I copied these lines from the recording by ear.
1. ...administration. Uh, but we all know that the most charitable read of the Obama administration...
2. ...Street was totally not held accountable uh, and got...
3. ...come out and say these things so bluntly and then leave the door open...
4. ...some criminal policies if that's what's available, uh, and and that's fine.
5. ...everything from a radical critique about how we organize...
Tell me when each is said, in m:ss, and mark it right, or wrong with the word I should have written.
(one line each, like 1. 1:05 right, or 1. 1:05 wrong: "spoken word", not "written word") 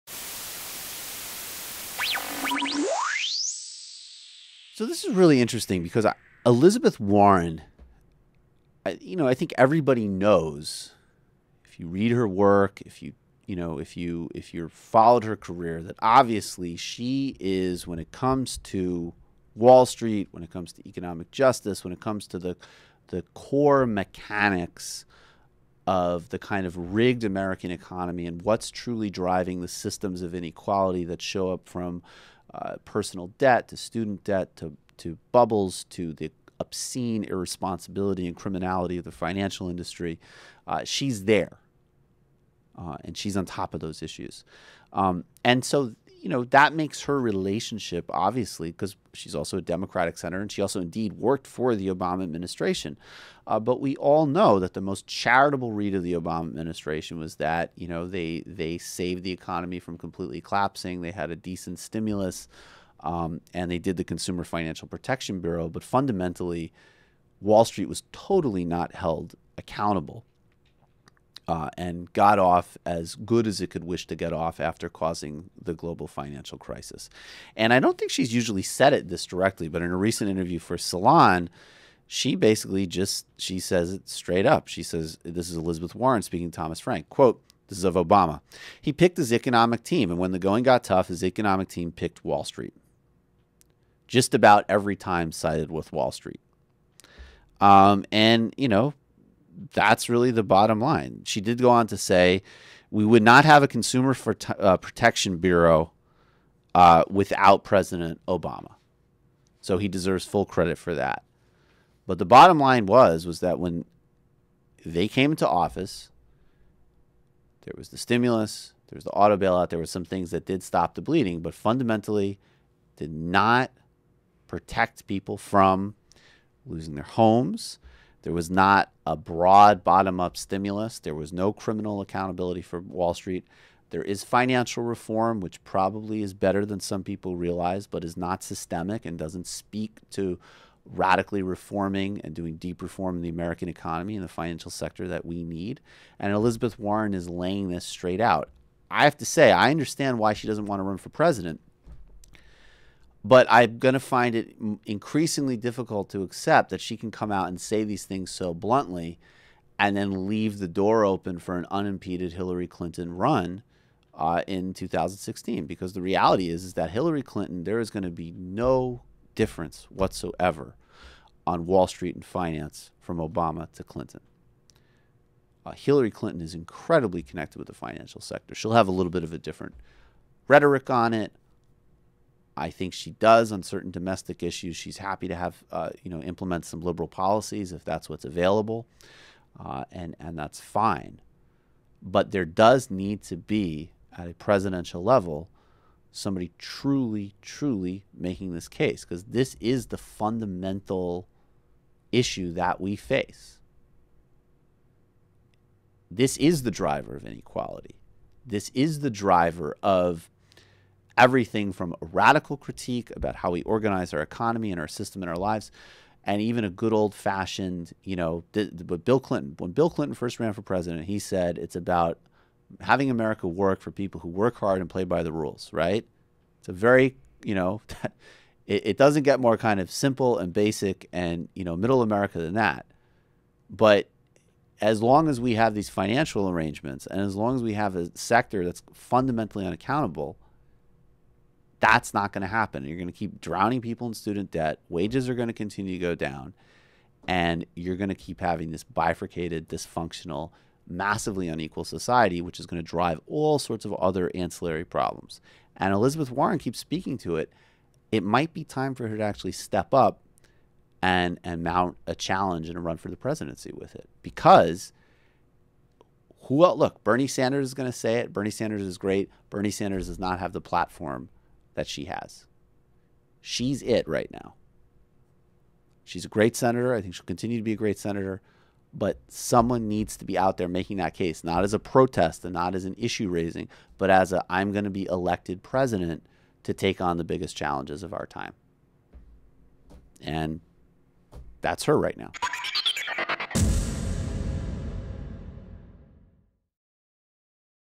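1. 0:52 right
2. 1:07 right
3. 2:37 right
4. 3:06 wrong: "liberal", not "criminal"
5. 3:31 right.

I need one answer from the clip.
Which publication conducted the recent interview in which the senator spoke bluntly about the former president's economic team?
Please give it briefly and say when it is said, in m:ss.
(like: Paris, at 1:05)
Salon, at 1:20.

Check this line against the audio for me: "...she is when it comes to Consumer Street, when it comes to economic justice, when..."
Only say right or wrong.
wrong.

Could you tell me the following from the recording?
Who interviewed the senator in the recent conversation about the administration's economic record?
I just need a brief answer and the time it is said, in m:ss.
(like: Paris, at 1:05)
Thomas Frank, at 1:26.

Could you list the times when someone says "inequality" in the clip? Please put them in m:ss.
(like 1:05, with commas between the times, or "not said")
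0:30, 3:27.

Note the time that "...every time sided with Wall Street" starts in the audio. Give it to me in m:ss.
1:34.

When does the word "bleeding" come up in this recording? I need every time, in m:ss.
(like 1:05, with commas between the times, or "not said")
2:01.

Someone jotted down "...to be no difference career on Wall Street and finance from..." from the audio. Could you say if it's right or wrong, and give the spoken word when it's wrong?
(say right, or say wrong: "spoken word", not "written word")
wrong: "whatsoever", not "career".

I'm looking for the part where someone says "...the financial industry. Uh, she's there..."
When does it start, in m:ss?
0:39.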